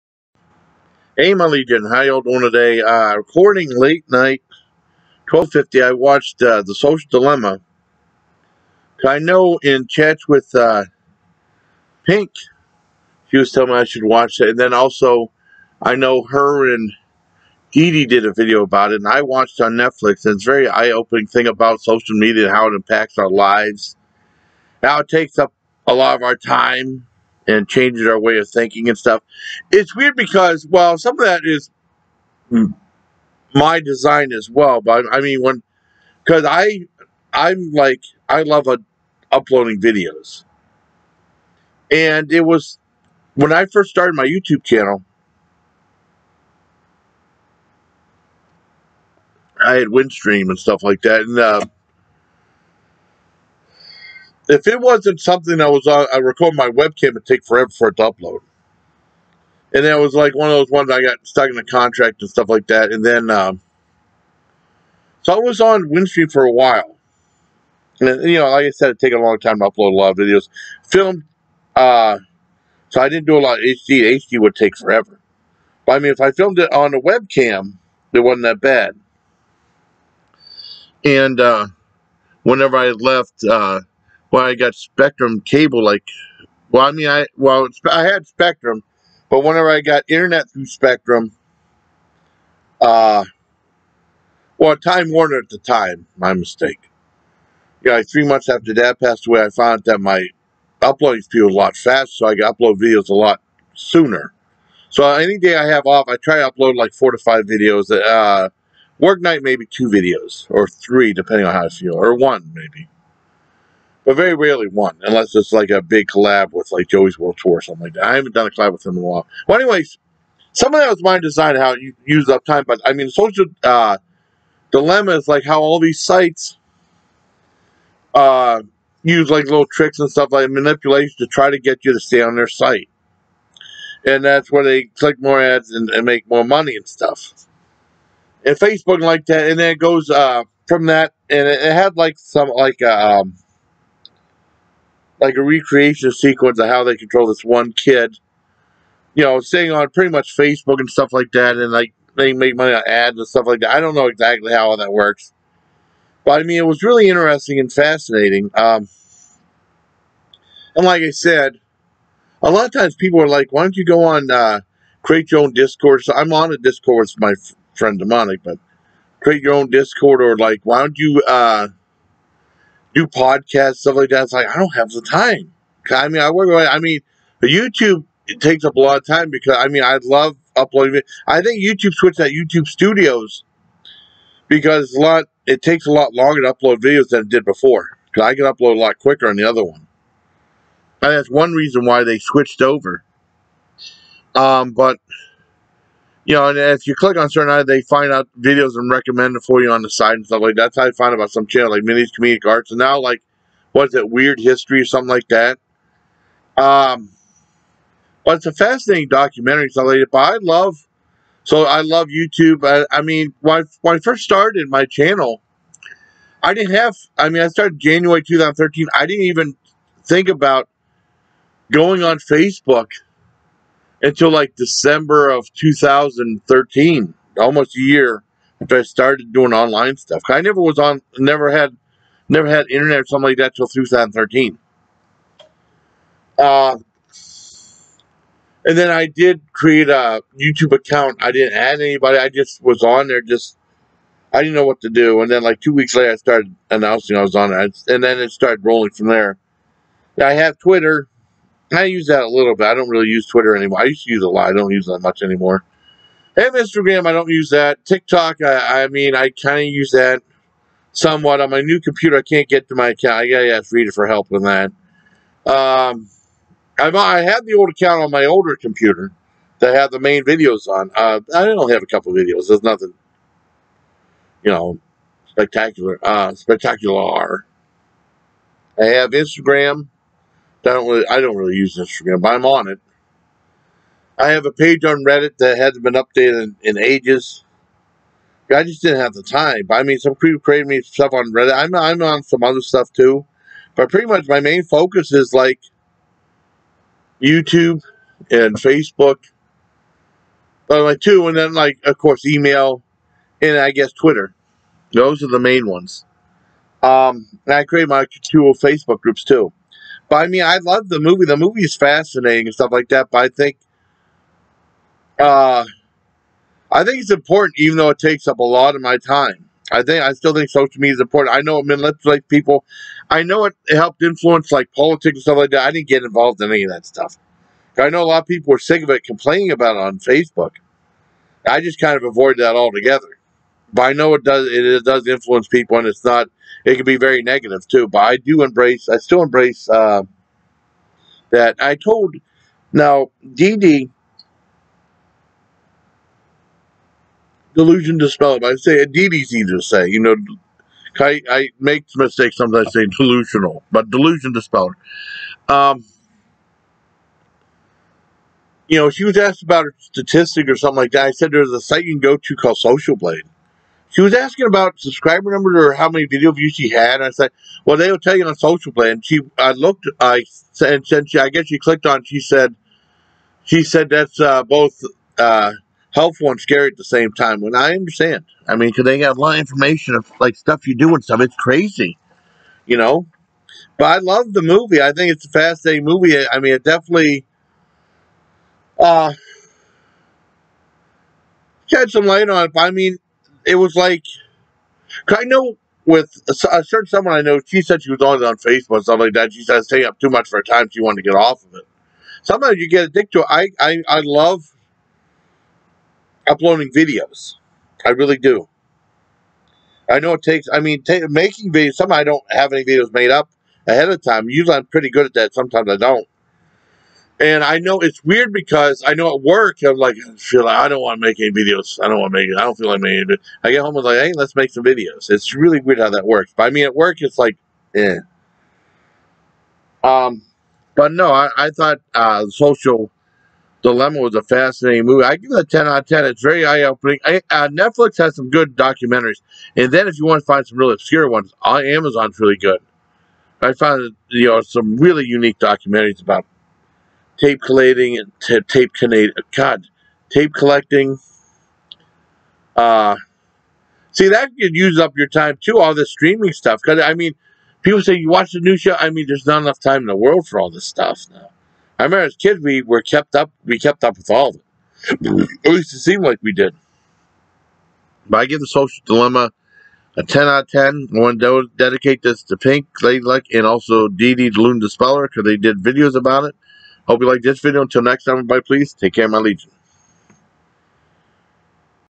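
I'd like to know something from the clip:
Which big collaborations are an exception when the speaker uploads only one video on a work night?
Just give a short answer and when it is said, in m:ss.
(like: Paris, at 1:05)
Joey's World Tour, at 1:56.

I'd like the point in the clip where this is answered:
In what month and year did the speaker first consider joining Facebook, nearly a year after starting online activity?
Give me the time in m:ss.
3:44.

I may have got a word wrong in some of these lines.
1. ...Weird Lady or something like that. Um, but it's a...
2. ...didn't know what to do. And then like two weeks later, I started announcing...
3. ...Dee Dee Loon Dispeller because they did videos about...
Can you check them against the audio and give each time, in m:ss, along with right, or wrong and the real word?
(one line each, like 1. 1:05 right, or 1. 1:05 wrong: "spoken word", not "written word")
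1. 3:24 wrong: "History", not "Lady"
2. 4:04 right
3. 7:53 right.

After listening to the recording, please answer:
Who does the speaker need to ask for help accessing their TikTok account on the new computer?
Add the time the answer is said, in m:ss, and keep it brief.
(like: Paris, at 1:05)
Rita, at 4:23.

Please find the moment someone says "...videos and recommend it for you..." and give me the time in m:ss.
3:18.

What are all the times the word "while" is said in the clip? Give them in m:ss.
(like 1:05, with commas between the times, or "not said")
1:06, 1:59.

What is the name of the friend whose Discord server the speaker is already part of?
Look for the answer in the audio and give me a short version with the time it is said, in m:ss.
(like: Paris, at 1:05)
Demonic, at 2:47.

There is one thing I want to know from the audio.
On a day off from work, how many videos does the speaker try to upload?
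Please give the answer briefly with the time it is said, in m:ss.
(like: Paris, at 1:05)
4 to 5, at 1:46.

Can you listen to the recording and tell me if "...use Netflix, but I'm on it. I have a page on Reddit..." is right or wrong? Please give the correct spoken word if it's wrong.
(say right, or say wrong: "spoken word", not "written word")
wrong: "Instagram", not "Netflix".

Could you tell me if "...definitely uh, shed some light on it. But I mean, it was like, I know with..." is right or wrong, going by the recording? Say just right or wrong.
right.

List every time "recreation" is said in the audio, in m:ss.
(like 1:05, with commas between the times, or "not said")
2:25.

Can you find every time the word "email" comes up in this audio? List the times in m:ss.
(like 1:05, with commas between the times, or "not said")
5:02.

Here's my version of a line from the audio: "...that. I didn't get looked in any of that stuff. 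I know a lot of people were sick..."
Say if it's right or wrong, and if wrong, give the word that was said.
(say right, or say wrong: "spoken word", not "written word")
wrong: "involved", not "looked".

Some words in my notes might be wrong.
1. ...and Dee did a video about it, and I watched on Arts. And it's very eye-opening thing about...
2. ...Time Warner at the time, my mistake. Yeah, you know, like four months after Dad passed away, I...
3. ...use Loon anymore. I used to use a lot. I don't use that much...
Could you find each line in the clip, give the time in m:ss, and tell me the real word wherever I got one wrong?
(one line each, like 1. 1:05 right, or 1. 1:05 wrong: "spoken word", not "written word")
1. 0:16 wrong: "Netflix", not "Arts"
2. 1:34 wrong: "three", not "four"
3. 4:13 wrong: "Twitter", not "Loon".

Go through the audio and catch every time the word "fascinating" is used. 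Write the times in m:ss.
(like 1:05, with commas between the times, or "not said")
2:37, 3:28, 5:11, 6:25, 7:14.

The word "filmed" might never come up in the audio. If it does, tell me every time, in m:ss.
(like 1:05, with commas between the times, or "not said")
1:10, 1:16.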